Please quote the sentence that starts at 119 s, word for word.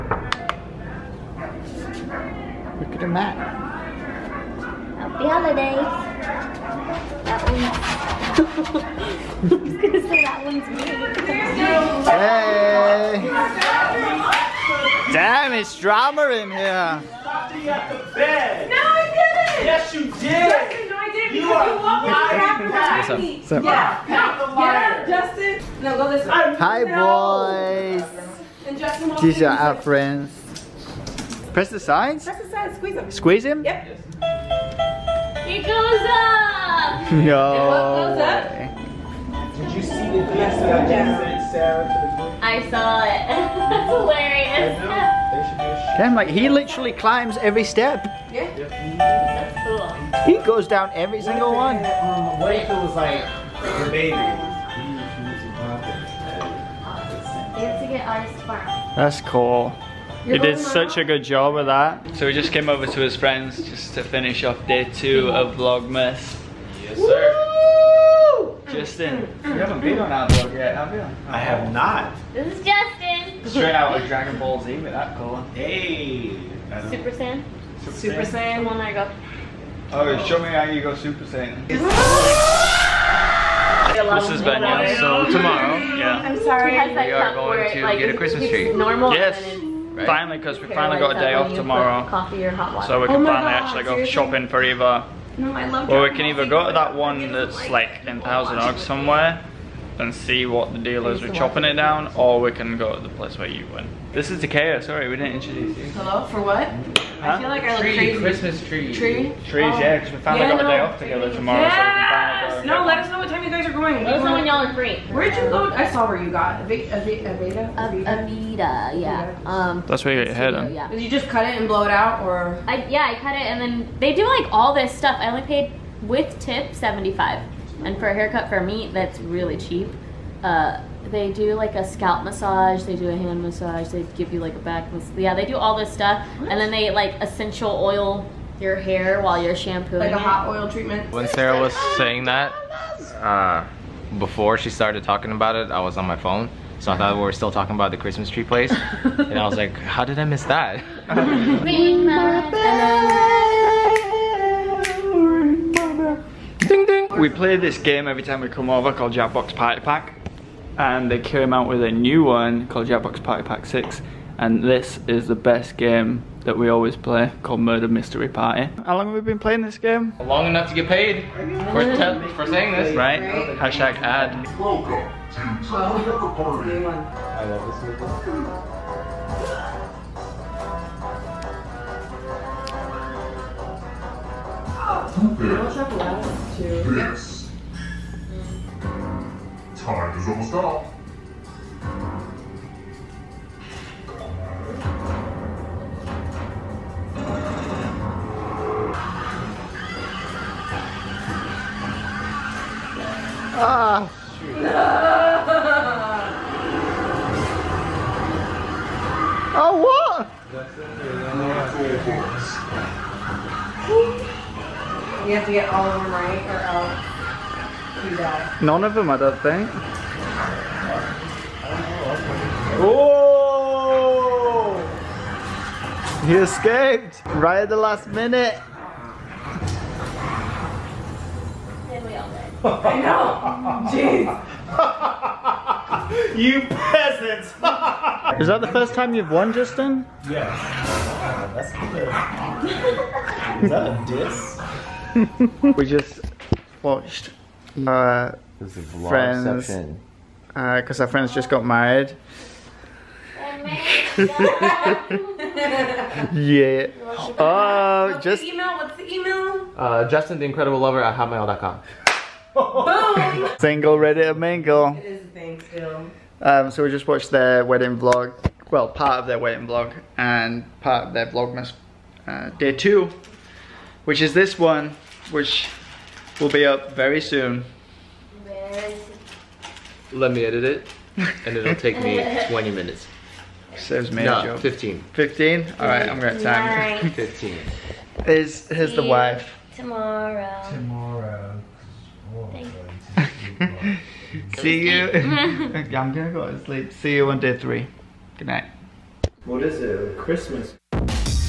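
Um, That's where you got your head on.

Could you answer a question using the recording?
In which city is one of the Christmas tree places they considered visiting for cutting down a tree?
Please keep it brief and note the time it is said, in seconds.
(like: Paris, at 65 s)
Thousand Oaks, at 98 s.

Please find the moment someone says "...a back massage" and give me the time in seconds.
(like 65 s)
134 s.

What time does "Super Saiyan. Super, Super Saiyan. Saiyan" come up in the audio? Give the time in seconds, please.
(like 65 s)
76 s.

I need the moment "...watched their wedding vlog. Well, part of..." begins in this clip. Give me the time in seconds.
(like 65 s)
267 s.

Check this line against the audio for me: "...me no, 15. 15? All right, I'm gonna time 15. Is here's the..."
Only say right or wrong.
right.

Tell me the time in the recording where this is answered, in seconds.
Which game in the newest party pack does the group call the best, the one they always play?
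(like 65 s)
167 s.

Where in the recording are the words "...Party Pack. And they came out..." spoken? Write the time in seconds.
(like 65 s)
159 s.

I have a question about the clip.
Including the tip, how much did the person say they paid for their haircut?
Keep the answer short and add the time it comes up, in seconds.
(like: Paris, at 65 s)
75, at 126 s.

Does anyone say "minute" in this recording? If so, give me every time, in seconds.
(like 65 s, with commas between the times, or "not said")
228 s, 282 s.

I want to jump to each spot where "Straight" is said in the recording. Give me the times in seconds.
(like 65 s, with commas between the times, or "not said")
73 s.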